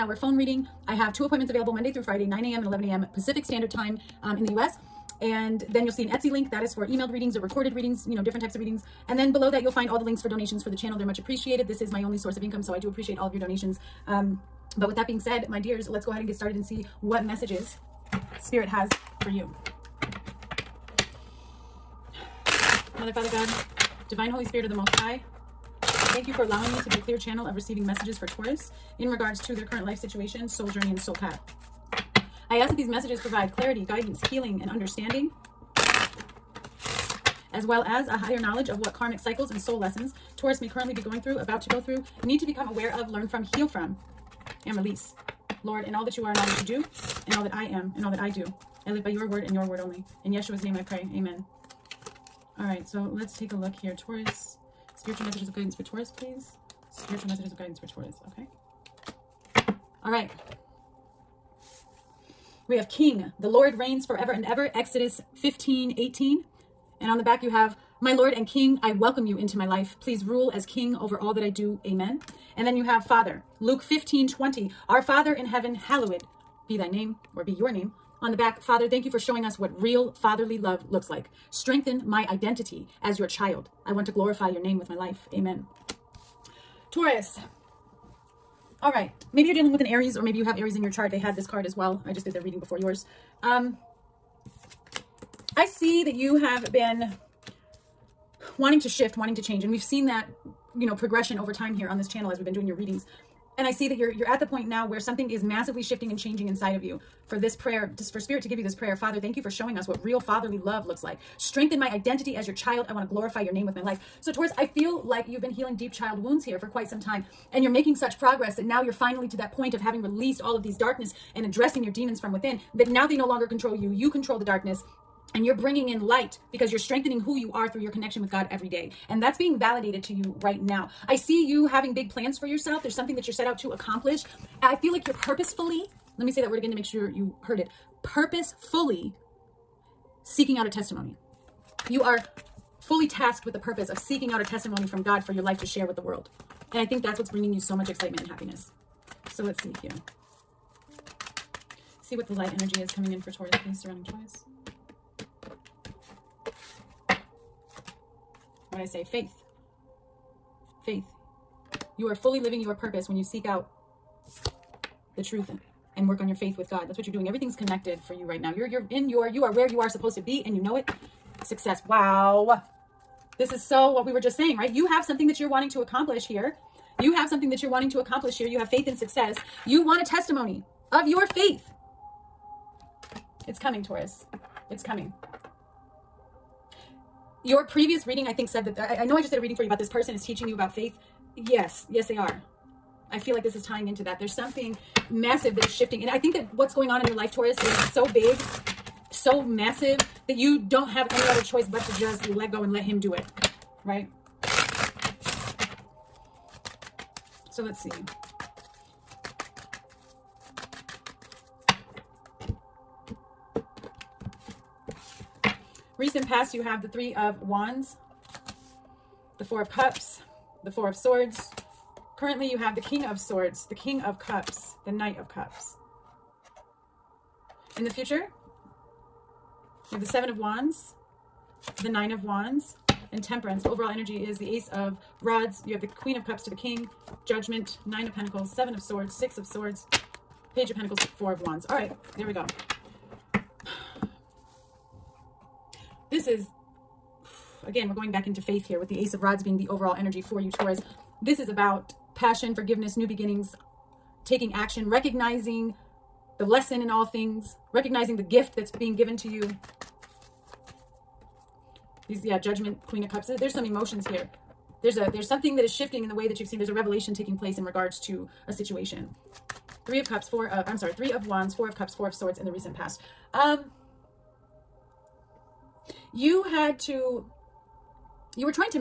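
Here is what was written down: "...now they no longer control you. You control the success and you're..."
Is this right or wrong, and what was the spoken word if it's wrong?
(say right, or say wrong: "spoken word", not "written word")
wrong: "darkness", not "success".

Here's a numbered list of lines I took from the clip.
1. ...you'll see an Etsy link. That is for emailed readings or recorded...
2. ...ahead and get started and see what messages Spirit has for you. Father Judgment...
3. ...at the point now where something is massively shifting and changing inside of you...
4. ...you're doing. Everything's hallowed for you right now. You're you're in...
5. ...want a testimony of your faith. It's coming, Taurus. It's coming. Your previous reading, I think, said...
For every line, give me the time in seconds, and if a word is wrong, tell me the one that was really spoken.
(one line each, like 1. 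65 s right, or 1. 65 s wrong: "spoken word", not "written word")
1. 5 s right
2. 16 s wrong: "God", not "Judgment"
3. 104 s right
4. 167 s wrong: "connected", not "hallowed"
5. 179 s right.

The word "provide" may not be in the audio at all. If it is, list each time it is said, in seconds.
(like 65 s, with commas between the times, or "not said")
33 s.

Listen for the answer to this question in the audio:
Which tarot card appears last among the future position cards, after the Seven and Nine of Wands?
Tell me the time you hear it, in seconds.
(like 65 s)
233 s.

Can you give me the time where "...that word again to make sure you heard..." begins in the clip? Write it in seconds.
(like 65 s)
136 s.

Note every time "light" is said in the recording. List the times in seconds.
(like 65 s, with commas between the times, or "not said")
126 s, 152 s.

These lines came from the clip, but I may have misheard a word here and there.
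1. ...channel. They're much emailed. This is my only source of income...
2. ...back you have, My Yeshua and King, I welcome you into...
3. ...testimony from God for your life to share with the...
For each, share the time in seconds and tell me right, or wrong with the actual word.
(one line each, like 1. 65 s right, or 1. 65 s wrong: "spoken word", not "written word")
1. 10 s wrong: "appreciated", not "emailed"
2. 67 s wrong: "Lord", not "Yeshua"
3. 144 s right.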